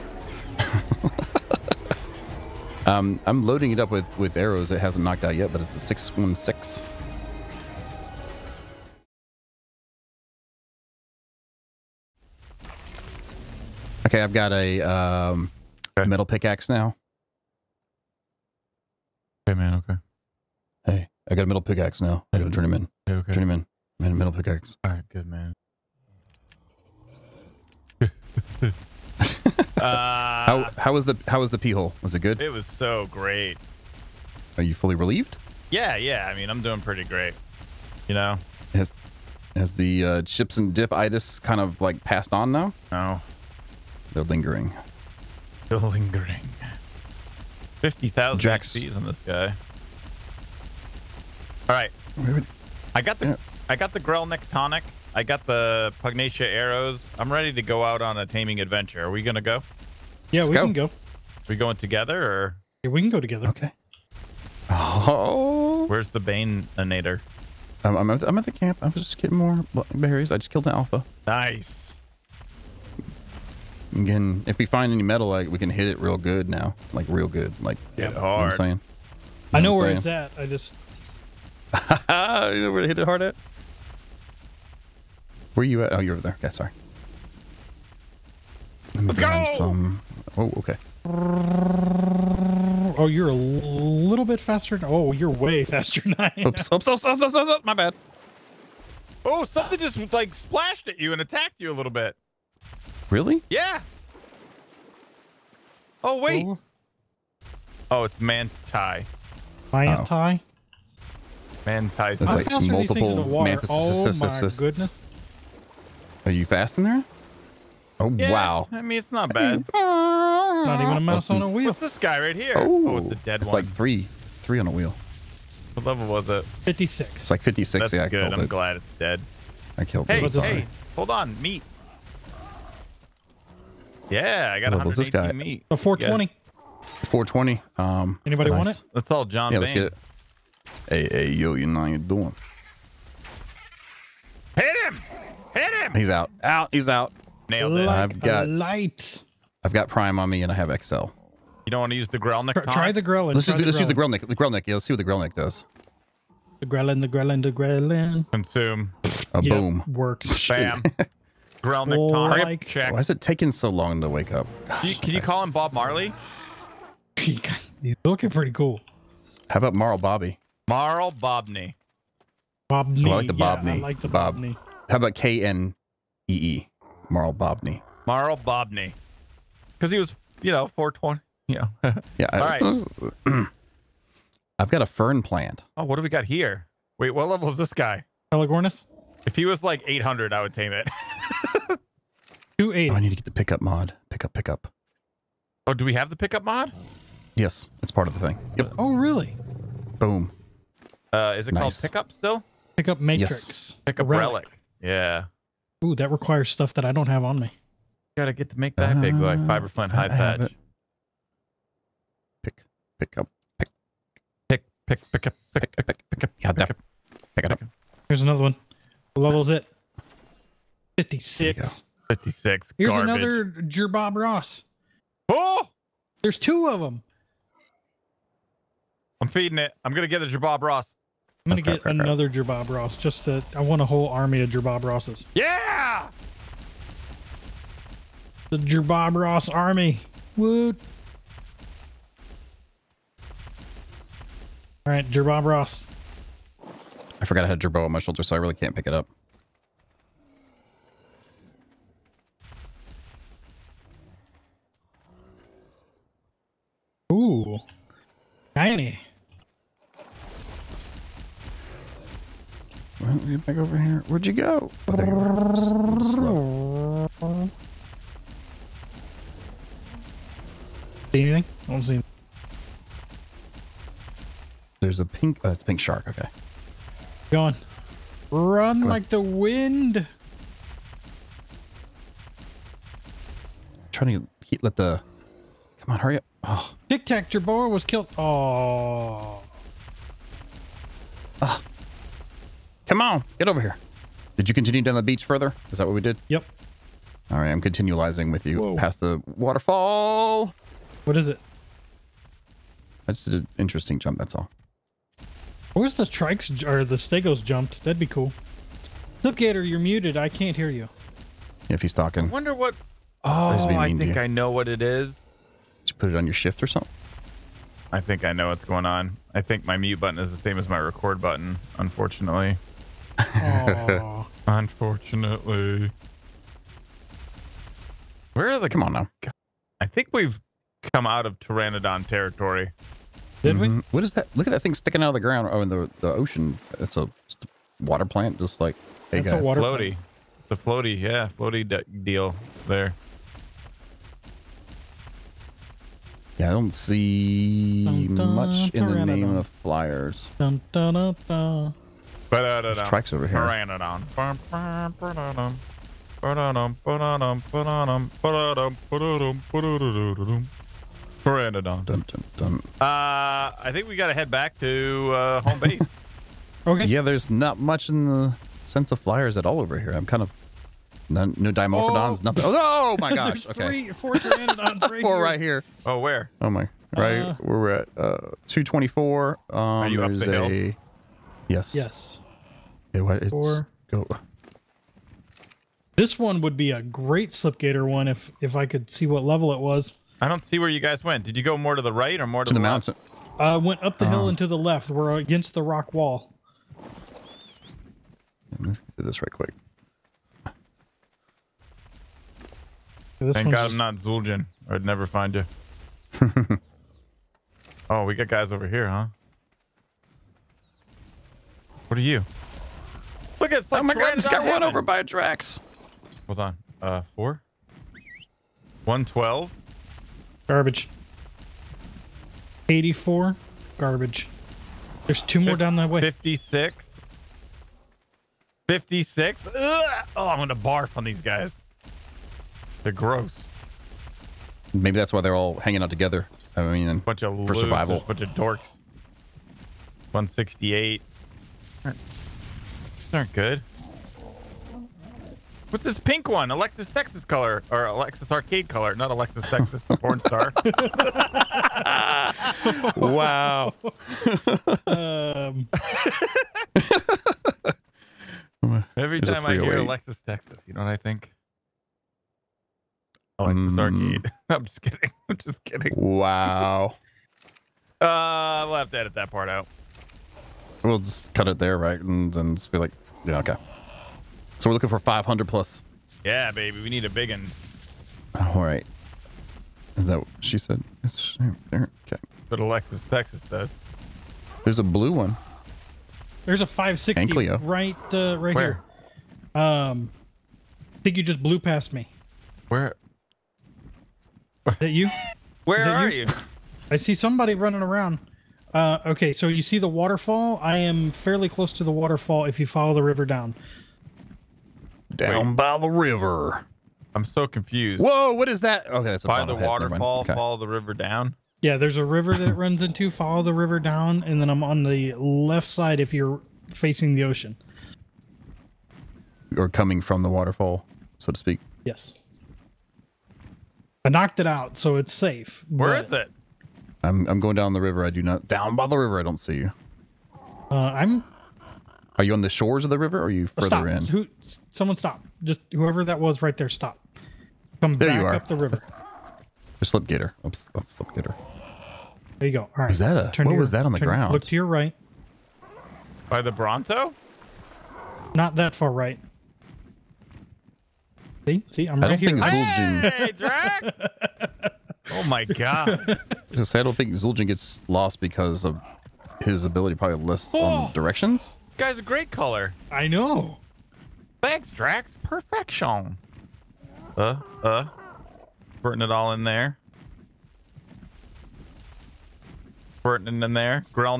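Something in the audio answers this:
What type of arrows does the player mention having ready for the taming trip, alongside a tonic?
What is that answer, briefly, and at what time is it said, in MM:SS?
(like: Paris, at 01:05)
Pugnacia arrows, at 00:56.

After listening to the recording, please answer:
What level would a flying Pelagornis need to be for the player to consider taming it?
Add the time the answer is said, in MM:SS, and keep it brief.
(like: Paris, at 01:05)
800, at 03:09.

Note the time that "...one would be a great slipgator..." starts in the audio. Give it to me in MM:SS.
06:26.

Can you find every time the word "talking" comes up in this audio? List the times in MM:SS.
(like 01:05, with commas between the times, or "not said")
05:11.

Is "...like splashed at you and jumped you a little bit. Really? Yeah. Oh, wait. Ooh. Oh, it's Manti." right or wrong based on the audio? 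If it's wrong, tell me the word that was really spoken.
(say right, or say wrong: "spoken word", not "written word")
wrong: "attacked", not "jumped".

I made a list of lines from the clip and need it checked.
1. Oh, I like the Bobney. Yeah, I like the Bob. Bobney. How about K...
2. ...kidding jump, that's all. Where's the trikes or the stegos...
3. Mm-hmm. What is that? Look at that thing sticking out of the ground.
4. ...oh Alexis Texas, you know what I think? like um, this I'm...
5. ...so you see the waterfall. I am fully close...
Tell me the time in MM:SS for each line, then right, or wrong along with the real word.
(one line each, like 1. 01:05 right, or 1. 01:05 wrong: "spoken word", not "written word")
1. 02:53 right
2. 05:03 wrong: "interesting", not "kidding"
3. 05:33 right
4. 07:39 right
5. 08:19 wrong: "fairly", not "fully".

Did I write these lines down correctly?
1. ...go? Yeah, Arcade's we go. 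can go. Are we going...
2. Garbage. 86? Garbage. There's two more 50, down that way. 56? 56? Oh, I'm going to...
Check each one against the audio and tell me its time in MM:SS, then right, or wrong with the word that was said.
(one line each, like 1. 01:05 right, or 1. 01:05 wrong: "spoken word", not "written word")
1. 00:59 wrong: "Let", not "Arcade"
2. 07:00 wrong: "84", not "86".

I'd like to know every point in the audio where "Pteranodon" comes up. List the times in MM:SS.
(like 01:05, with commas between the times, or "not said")
05:31, 05:53.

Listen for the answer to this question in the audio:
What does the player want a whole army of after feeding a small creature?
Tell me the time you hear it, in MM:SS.
03:54.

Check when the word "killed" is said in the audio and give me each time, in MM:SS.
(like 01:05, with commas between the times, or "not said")
01:10, 02:09, 04:47.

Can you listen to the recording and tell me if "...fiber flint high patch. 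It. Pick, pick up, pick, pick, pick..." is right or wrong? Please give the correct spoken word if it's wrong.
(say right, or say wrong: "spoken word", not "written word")
right.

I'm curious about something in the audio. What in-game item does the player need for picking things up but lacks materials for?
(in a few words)
Pickup relic.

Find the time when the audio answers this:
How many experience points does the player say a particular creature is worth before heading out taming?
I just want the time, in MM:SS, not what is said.
00:47.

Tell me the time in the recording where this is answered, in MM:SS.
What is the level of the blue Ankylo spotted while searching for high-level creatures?
08:06.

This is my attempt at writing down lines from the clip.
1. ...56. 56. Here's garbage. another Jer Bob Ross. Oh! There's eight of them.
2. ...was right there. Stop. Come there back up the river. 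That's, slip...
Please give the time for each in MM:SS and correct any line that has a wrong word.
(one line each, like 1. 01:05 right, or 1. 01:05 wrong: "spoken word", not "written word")
1. 03:40 wrong: "two", not "eight"
2. 08:56 right.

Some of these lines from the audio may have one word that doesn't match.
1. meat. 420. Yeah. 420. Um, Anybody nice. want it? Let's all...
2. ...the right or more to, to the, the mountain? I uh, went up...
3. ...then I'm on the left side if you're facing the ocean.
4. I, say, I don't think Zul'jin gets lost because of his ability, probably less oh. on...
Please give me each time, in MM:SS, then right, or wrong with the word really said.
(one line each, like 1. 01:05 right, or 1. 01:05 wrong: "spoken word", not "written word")
1. 02:15 right
2. 06:31 right
3. 08:34 right
4. 09:16 right.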